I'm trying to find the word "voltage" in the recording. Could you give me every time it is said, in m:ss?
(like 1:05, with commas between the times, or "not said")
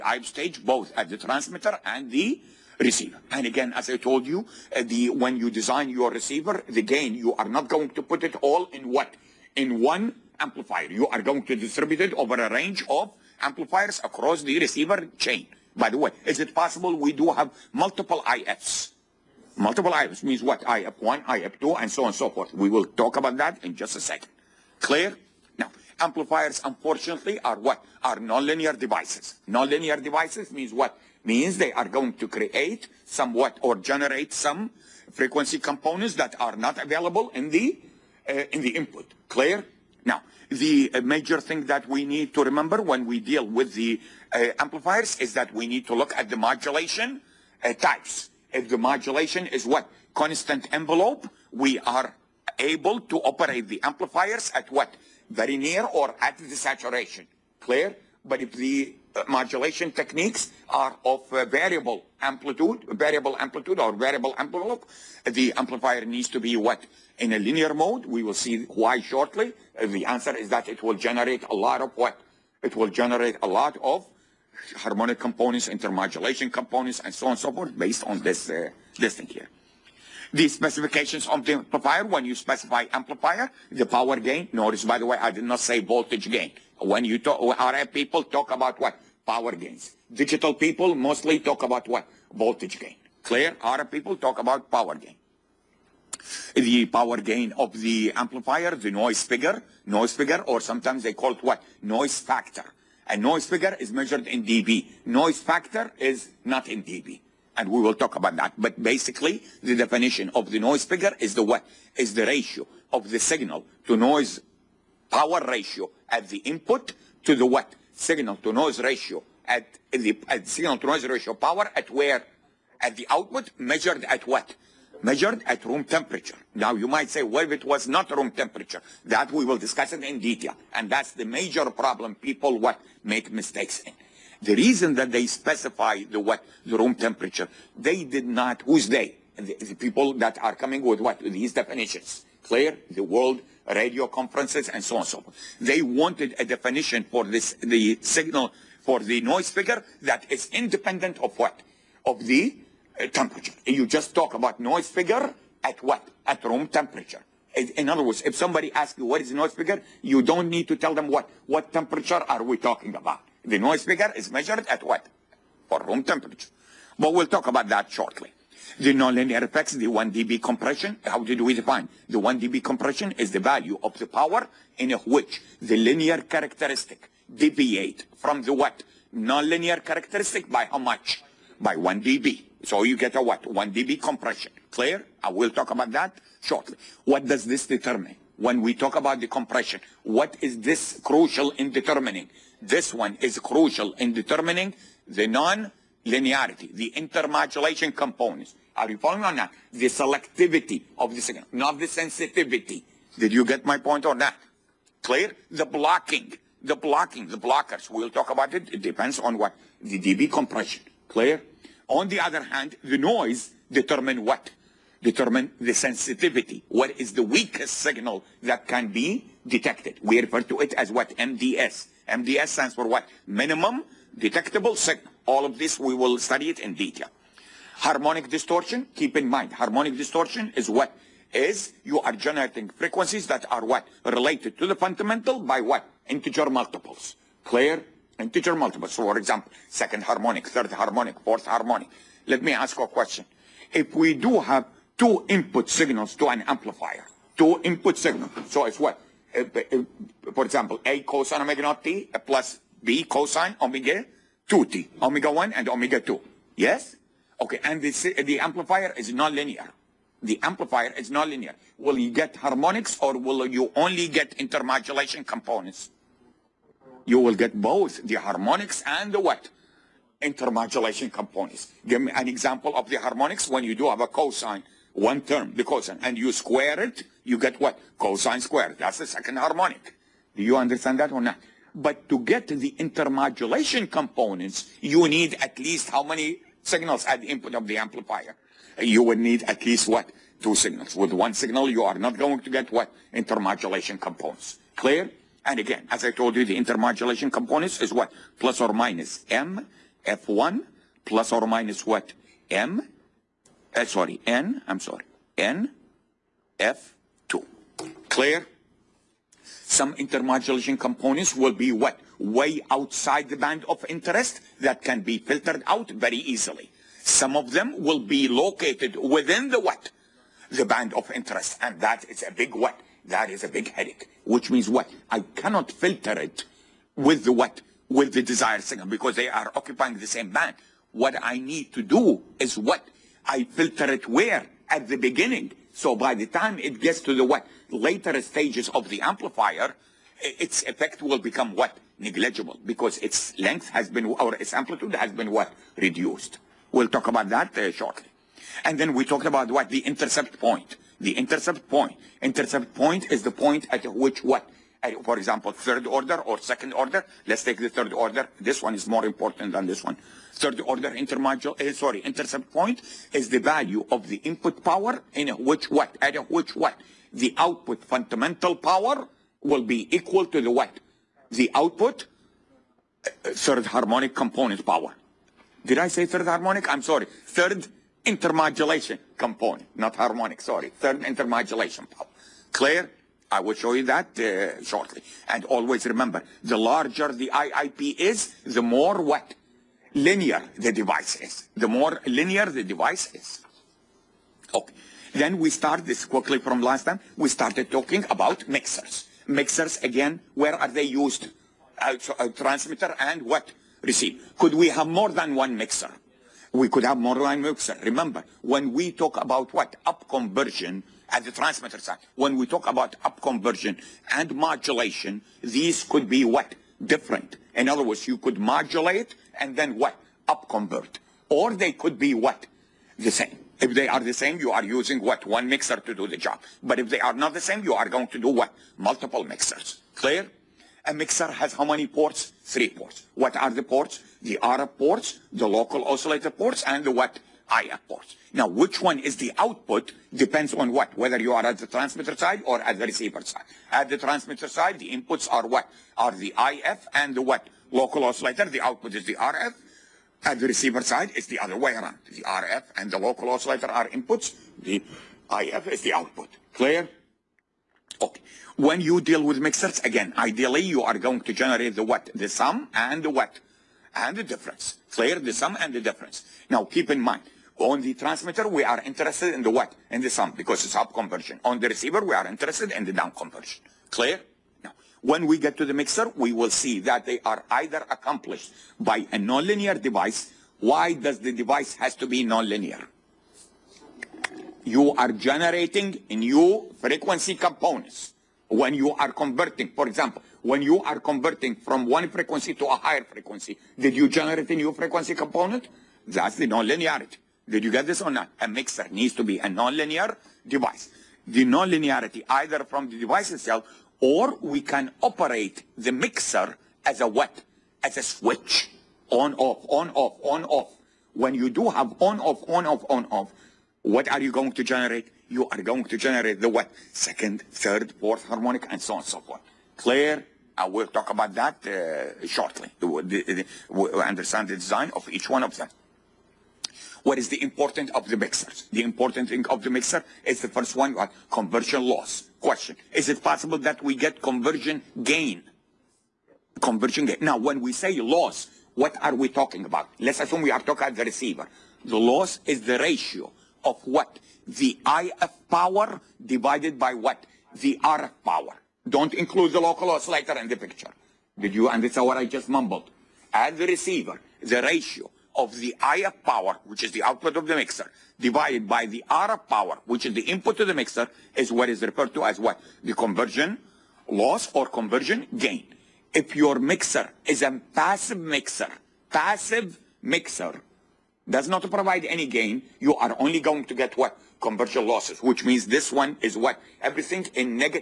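1:25, 1:32.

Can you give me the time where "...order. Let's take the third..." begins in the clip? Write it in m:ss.
5:56.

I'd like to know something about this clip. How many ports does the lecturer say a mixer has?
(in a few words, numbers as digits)
Three.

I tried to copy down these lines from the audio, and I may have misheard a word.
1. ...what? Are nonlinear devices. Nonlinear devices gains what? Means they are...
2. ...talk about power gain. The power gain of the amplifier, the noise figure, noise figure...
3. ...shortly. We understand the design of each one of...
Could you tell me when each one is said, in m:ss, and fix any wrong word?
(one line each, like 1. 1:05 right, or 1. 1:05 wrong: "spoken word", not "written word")
1. 0:27 wrong: "means", not "gains"
2. 1:34 right
3. 8:42 right.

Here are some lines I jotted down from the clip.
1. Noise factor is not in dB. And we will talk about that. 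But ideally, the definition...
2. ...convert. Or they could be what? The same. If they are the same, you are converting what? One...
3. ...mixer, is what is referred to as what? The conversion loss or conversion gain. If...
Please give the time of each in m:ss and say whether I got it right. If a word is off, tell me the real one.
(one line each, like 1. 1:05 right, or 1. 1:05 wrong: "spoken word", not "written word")
1. 1:45 wrong: "basically", not "ideally"
2. 7:00 wrong: "using", not "converting"
3. 9:20 right.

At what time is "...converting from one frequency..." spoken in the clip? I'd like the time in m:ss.
8:10.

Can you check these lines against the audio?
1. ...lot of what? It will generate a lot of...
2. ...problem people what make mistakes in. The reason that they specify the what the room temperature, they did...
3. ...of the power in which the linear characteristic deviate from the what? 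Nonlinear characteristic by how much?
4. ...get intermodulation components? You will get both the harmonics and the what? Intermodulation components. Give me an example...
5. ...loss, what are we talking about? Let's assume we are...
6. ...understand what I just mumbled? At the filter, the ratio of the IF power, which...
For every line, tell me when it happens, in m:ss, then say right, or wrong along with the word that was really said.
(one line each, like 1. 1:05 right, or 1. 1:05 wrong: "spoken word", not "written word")
1. 1:11 right
2. 2:11 right
3. 2:53 right
4. 4:24 right
5. 8:57 right
6. 9:11 wrong: "receiver", not "filter".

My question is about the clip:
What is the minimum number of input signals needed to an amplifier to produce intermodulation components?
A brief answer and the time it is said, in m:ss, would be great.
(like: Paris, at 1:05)
Two signals, at 4:50.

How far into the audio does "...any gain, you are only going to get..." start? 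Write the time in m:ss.
9:32.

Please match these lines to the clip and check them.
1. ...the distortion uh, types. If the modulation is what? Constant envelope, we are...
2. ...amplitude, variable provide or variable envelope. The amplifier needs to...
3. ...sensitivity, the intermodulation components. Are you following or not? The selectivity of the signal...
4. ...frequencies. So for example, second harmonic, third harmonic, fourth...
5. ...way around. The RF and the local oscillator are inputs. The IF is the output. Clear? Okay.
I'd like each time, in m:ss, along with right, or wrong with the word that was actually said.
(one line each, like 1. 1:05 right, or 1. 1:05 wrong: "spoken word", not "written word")
1. 0:46 wrong: "modulation", not "distortion"
2. 1:02 wrong: "amplitude", not "provide"
3. 3:16 wrong: "linearity", not "sensitivity"
4. 3:58 wrong: "multiples", not "frequencies"
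5. 7:31 right.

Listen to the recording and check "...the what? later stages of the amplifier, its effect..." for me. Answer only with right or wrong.
right.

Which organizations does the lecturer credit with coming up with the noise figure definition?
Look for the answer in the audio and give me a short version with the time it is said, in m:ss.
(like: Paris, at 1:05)
World radio conferences, at 2:22.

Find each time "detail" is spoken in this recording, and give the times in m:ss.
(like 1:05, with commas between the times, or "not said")
2:10, 3:46.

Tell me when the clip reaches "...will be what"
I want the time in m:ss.
5:11.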